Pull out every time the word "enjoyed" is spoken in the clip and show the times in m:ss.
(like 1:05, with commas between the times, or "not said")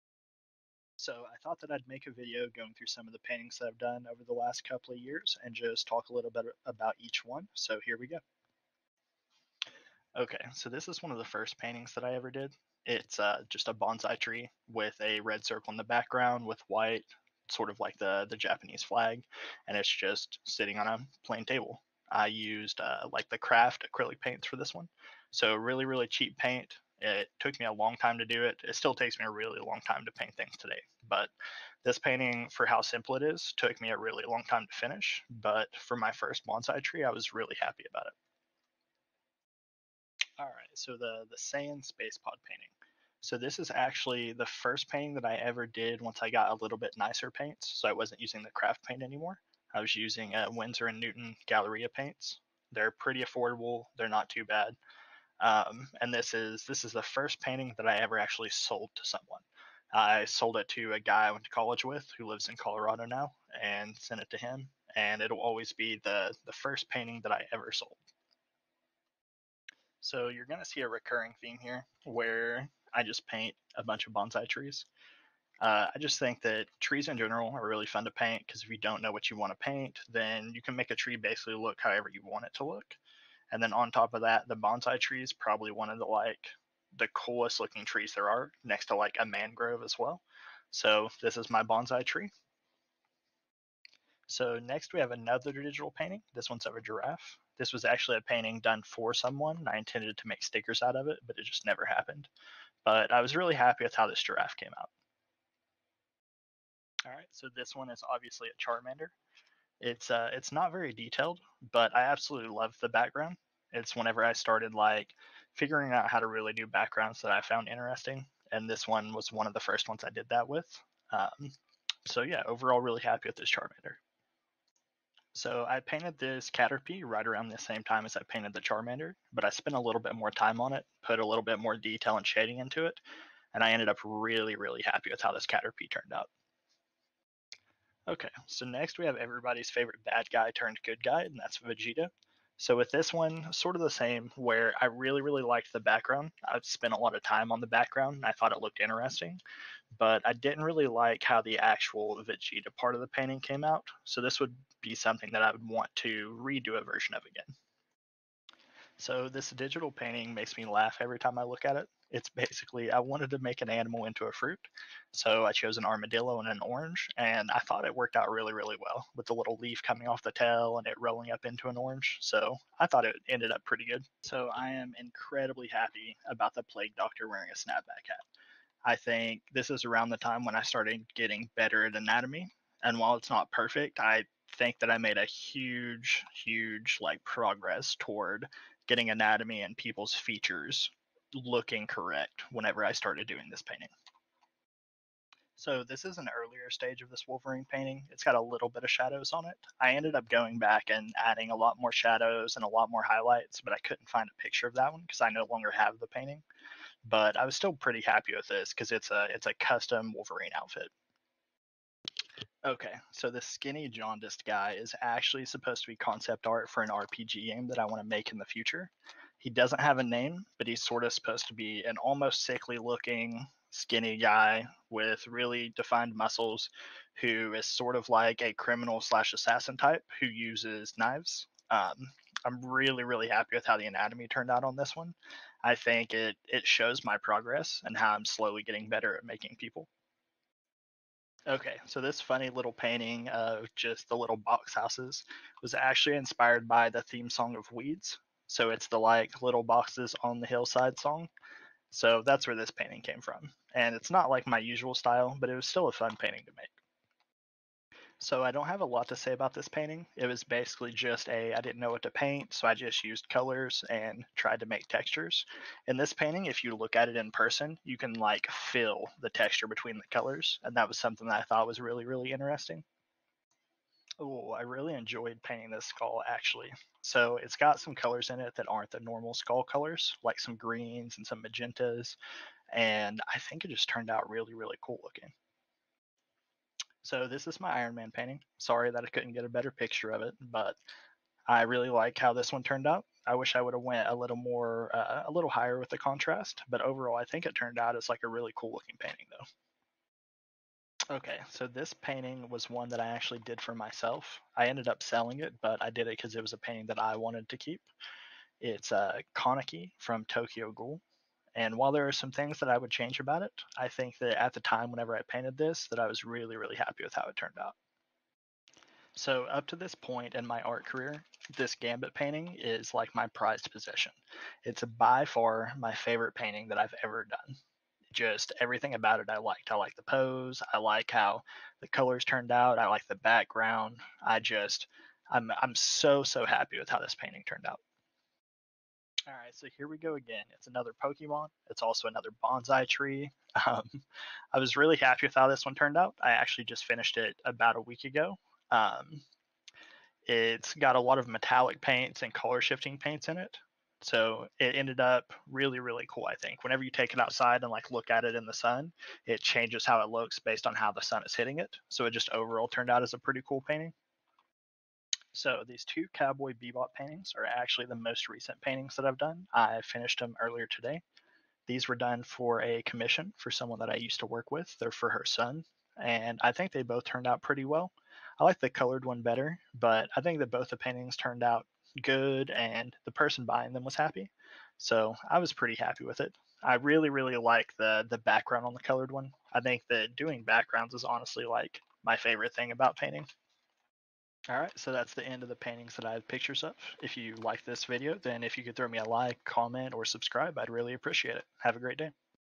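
4:34.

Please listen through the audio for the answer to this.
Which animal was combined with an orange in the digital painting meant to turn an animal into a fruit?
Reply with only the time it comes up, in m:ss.
2:45.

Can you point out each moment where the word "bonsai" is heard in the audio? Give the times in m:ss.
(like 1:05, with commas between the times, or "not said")
0:13, 0:36, 1:14, 1:24, 1:31, 5:42.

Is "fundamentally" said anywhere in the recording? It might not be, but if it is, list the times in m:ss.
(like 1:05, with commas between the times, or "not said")
not said.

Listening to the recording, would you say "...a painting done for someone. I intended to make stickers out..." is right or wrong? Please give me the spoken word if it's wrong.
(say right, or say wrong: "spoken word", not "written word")
right.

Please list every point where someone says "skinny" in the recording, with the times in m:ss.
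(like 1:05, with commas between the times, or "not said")
3:33, 3:43.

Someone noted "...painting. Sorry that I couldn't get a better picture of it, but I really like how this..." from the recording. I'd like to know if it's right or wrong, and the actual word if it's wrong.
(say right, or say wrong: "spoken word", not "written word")
right.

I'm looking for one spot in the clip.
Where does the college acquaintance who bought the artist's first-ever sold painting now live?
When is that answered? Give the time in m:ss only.
1:02.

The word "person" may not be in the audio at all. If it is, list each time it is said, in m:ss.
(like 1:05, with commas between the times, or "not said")
4:27, 6:23.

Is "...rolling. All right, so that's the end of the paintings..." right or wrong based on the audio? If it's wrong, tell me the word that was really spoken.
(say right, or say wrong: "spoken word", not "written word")
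wrong: "painting", not "rolling".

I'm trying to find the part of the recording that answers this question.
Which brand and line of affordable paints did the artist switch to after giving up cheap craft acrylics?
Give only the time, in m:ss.
0:50.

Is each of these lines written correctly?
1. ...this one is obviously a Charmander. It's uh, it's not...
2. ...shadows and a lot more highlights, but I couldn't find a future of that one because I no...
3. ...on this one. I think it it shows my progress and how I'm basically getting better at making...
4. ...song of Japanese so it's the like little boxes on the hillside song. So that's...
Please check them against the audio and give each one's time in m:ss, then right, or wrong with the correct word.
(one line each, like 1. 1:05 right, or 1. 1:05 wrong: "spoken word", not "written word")
1. 1:47 right
2. 3:21 wrong: "picture", not "future"
3. 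3:54 wrong: "slowly", not "basically"
4. 4:07 wrong: "Weeds", not "Japanese".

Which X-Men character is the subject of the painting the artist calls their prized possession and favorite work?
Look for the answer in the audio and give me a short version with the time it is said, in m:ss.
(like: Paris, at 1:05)
Gambit, at 5:21.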